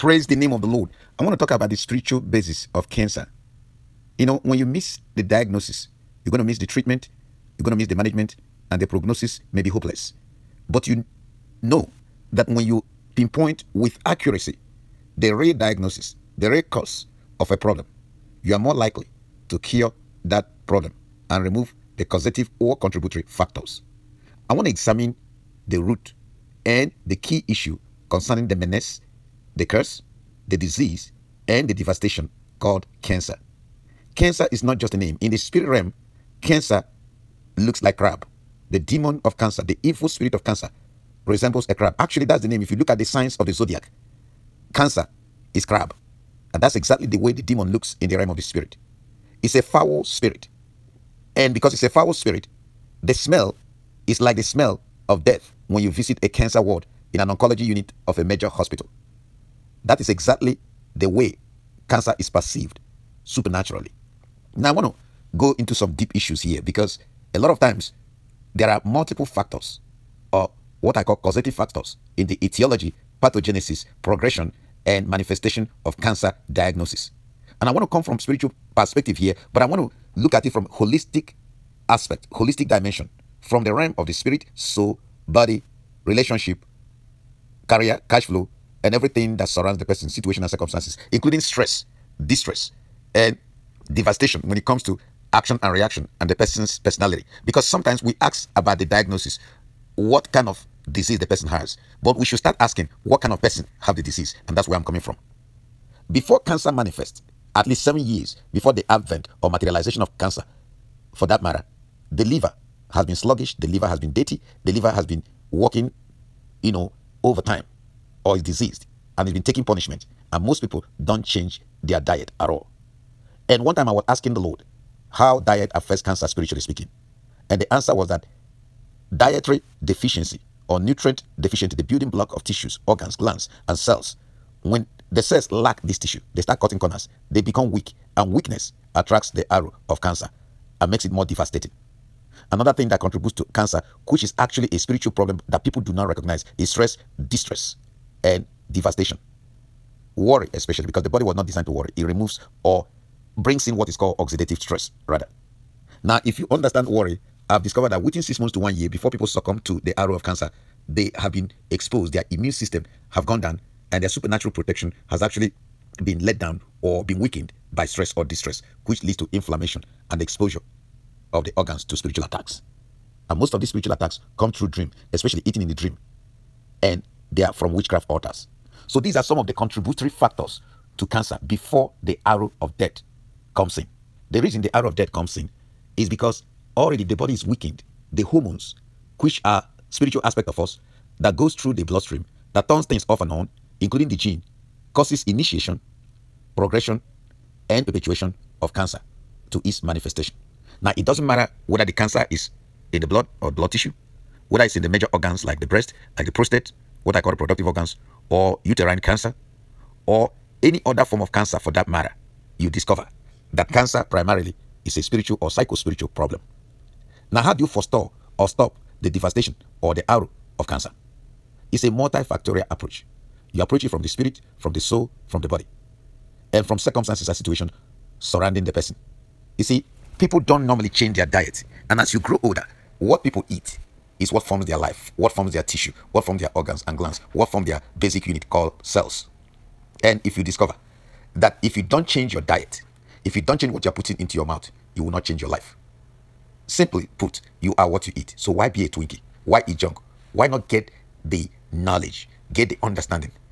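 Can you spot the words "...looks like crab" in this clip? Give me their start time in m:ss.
0:37.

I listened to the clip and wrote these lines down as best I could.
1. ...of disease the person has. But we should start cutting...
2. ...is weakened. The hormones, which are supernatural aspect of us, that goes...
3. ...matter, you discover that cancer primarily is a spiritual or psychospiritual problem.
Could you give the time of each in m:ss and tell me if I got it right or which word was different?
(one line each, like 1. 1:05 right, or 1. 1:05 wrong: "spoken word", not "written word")
1. 1:40 wrong: "asking", not "cutting"
2. 3:07 wrong: "spiritual", not "supernatural"
3. 3:31 right.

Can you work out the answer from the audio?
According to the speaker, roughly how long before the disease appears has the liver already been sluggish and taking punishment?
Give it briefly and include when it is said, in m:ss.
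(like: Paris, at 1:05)
7 years, at 1:47.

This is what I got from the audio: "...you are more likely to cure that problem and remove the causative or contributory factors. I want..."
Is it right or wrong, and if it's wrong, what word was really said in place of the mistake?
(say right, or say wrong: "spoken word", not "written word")
right.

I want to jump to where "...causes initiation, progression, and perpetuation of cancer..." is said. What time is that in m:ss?
3:14.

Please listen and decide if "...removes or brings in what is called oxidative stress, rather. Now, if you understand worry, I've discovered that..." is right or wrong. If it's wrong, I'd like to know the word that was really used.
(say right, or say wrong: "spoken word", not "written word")
right.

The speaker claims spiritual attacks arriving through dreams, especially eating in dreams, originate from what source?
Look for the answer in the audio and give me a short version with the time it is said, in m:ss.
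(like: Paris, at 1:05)
Witchcraft altars, at 2:57.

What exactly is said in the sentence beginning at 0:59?
That is exactly the way cancer is perceived supernaturally.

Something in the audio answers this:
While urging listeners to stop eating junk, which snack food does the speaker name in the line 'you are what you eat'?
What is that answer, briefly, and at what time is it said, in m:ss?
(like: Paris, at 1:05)
Twinkie, at 4:08.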